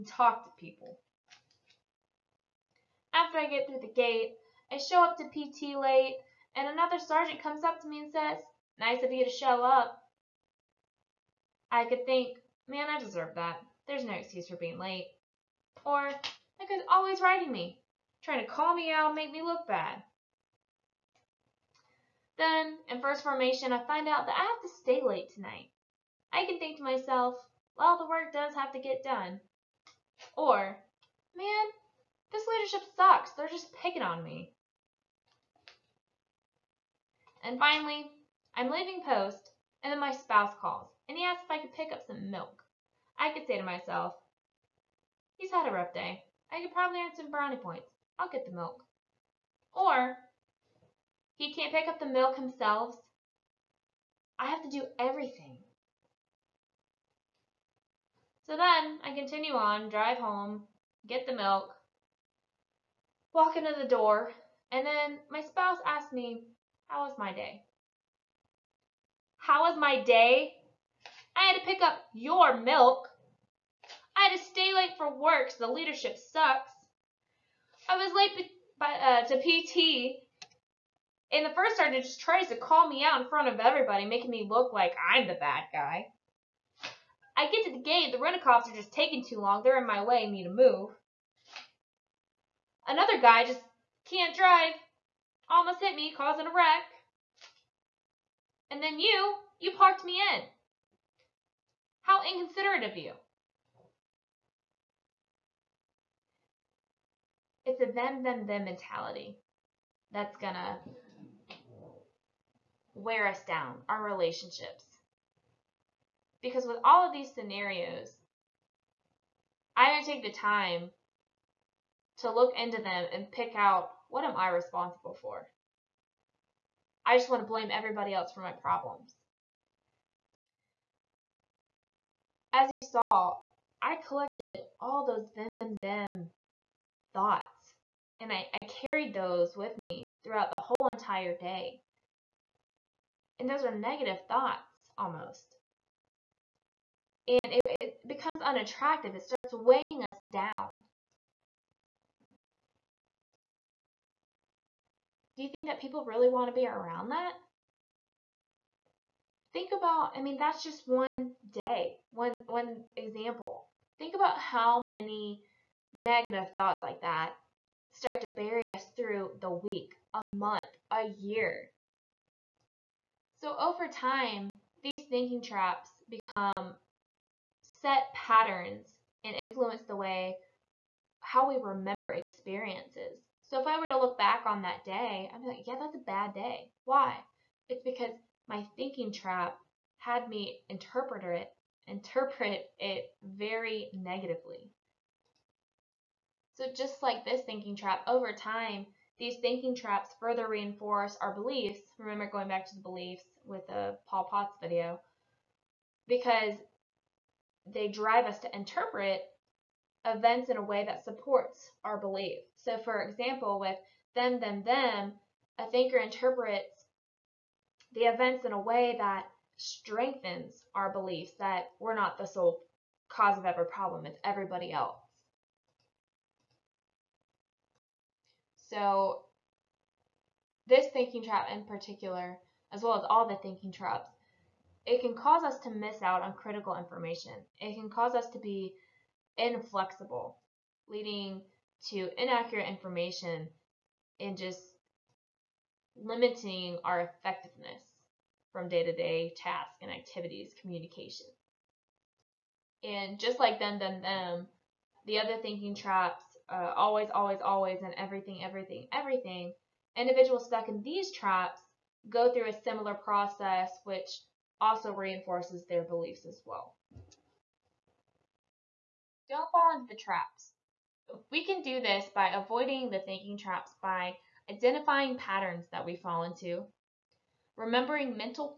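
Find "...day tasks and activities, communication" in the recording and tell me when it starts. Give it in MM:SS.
04:08.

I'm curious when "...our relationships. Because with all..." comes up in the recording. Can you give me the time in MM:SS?
01:53.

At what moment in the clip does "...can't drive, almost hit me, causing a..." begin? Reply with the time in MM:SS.
01:34.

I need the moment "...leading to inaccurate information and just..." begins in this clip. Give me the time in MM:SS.
04:00.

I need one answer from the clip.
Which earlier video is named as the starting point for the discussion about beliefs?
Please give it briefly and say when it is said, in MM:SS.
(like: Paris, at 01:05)
Paul Potts video, at 03:24.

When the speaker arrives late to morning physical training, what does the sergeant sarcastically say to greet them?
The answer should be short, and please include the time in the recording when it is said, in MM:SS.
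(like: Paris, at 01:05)
Nice of you to show up, at 00:08.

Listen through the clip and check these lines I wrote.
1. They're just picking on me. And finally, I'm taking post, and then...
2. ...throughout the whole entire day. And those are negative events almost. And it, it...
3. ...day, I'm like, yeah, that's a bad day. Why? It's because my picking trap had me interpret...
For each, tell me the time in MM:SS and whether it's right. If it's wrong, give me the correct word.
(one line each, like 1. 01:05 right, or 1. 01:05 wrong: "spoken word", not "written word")
1. 00:33 wrong: "leaving", not "taking"
2. 02:20 wrong: "thoughts", not "events"
3. 03:04 wrong: "thinking", not "picking".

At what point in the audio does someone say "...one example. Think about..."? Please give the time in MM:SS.
02:42.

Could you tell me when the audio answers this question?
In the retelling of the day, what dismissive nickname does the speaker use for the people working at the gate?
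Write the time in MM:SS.
01:28.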